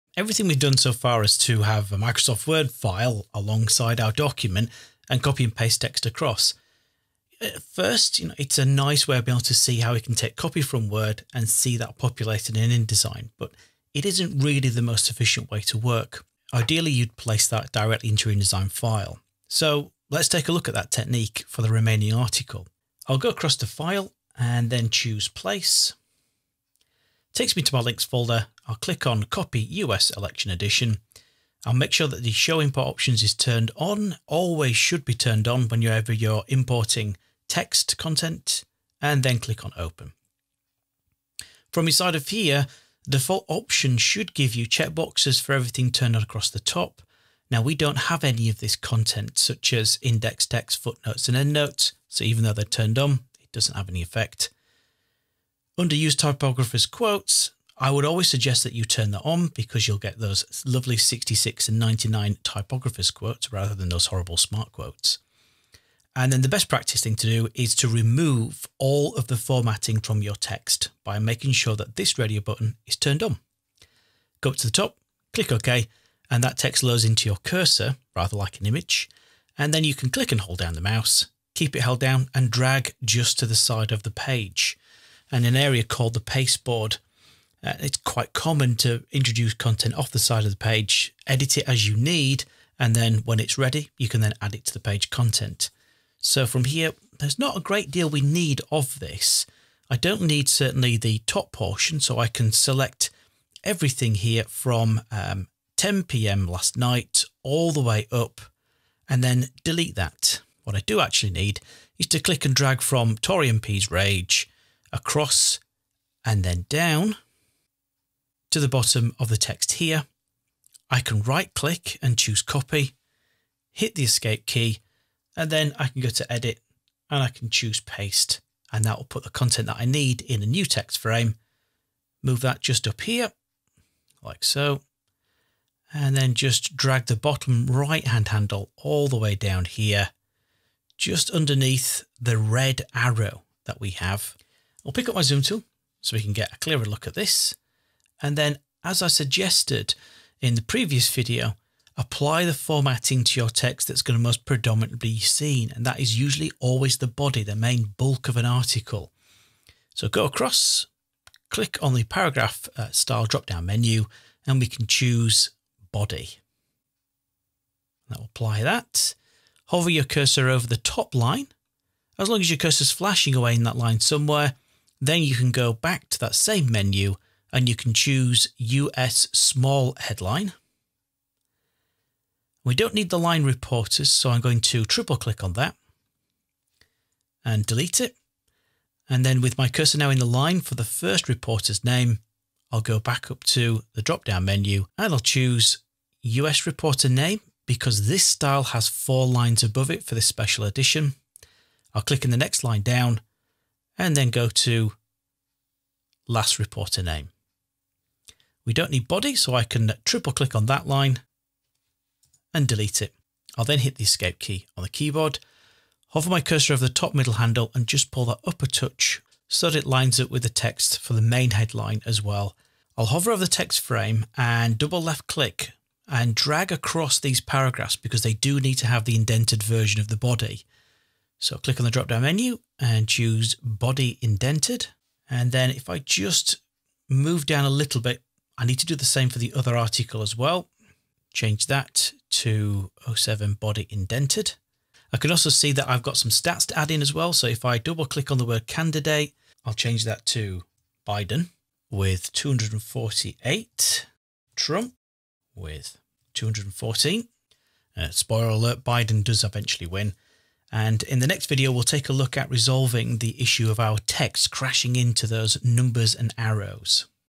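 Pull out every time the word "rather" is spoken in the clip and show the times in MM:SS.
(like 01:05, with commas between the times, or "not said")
01:03, 01:18.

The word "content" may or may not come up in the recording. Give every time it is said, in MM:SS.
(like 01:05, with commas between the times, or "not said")
00:37, 00:48, 01:29, 01:35, 02:09.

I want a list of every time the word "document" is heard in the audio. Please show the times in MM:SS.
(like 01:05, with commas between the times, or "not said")
00:04.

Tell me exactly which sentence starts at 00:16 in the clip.
Ideally, you'd place that directly into your InDesign file.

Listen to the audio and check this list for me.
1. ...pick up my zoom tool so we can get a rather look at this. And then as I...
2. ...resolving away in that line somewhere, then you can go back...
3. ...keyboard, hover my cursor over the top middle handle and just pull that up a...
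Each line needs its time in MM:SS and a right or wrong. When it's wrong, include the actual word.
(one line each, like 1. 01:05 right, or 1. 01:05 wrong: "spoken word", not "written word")
1. 02:24 wrong: "clearer", not "rather"
2. 02:52 wrong: "flashing", not "resolving"
3. 03:34 right.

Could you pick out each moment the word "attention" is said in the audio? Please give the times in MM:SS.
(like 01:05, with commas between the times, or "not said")
not said.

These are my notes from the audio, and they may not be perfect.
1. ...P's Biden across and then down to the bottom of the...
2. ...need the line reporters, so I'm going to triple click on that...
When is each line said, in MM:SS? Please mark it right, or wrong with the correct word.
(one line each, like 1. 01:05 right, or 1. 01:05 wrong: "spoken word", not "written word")
1. 01:53 wrong: "Rage", not "Biden"
2. 03:02 right.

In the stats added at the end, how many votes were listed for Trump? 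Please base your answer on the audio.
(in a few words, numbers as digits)
214.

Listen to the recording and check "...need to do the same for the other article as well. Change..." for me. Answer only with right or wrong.
right.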